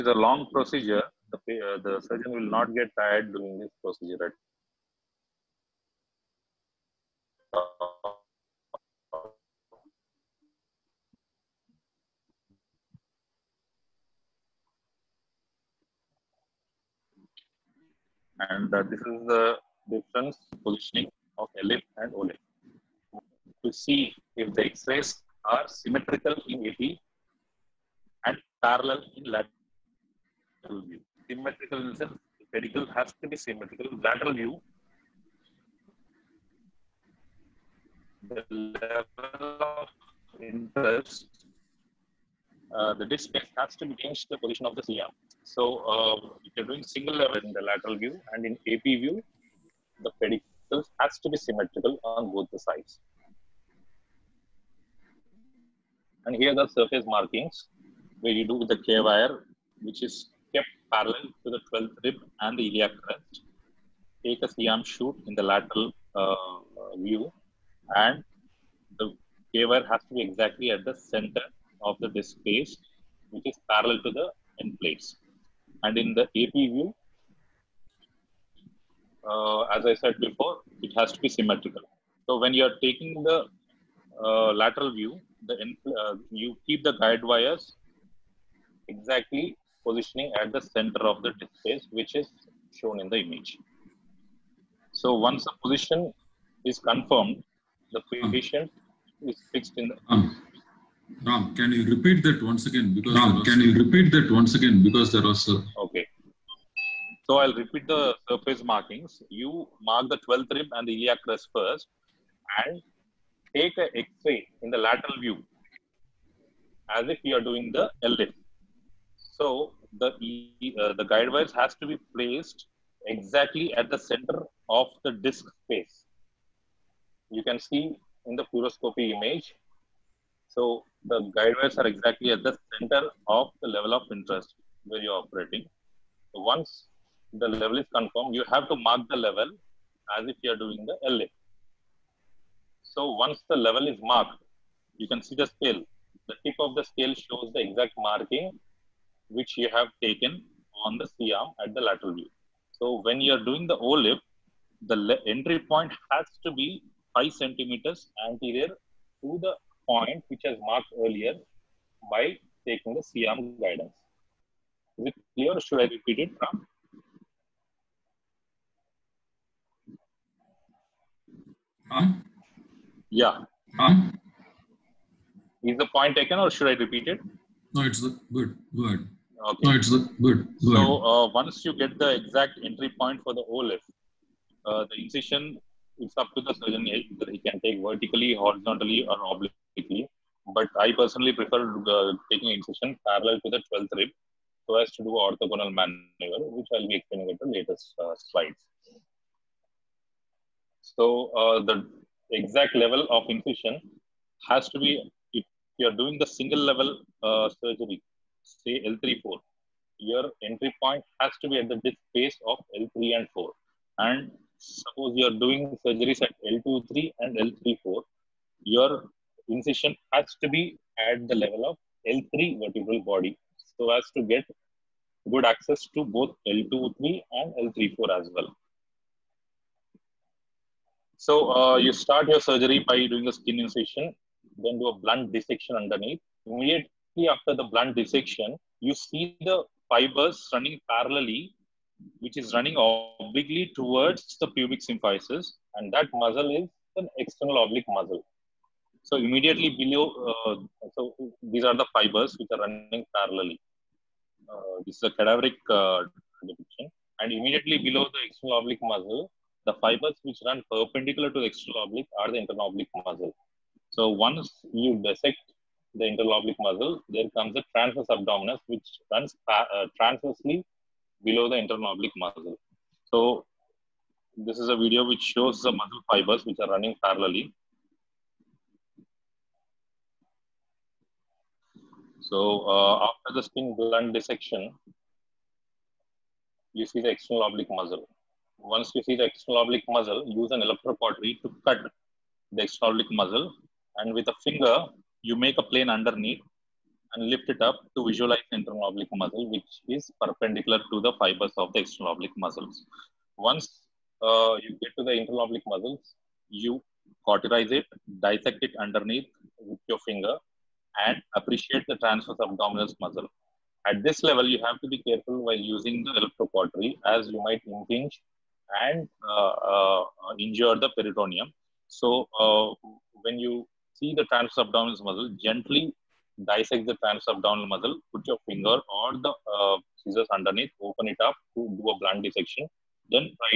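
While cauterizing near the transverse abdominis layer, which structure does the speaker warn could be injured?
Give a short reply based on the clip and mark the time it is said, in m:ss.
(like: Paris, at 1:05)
Peritoneum, at 5:20.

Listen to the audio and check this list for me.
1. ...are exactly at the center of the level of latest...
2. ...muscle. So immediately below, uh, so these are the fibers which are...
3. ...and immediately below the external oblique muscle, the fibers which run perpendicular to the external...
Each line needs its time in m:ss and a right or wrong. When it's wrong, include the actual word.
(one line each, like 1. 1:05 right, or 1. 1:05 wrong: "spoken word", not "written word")
1. 2:11 wrong: "interest", not "latest"
2. 4:07 right
3. 4:17 right.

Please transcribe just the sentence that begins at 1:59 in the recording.
So the, uh, the guide wires has to be placed exactly at the center of the disk space.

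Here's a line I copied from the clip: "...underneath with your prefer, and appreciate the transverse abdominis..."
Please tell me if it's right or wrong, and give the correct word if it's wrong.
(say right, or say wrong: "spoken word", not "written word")
wrong: "finger", not "prefer".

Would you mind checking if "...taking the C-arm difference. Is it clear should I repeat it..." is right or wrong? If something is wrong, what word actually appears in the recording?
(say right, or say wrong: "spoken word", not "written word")
wrong: "guidance", not "difference".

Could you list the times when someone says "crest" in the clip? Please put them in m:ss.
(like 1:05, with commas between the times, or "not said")
1:03, 1:51.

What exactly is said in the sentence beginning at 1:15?
And in the AP view, uh, as I said before, it has to be symmetrical.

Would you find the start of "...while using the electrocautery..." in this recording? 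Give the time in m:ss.
5:15.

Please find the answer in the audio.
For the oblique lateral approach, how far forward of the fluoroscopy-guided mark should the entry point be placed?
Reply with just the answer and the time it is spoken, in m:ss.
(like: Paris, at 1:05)
5 centimeters, at 2:37.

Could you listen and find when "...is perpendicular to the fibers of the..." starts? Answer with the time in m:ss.
4:59.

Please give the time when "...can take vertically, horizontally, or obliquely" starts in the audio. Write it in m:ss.
3:07.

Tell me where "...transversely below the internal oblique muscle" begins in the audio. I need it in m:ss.
4:29.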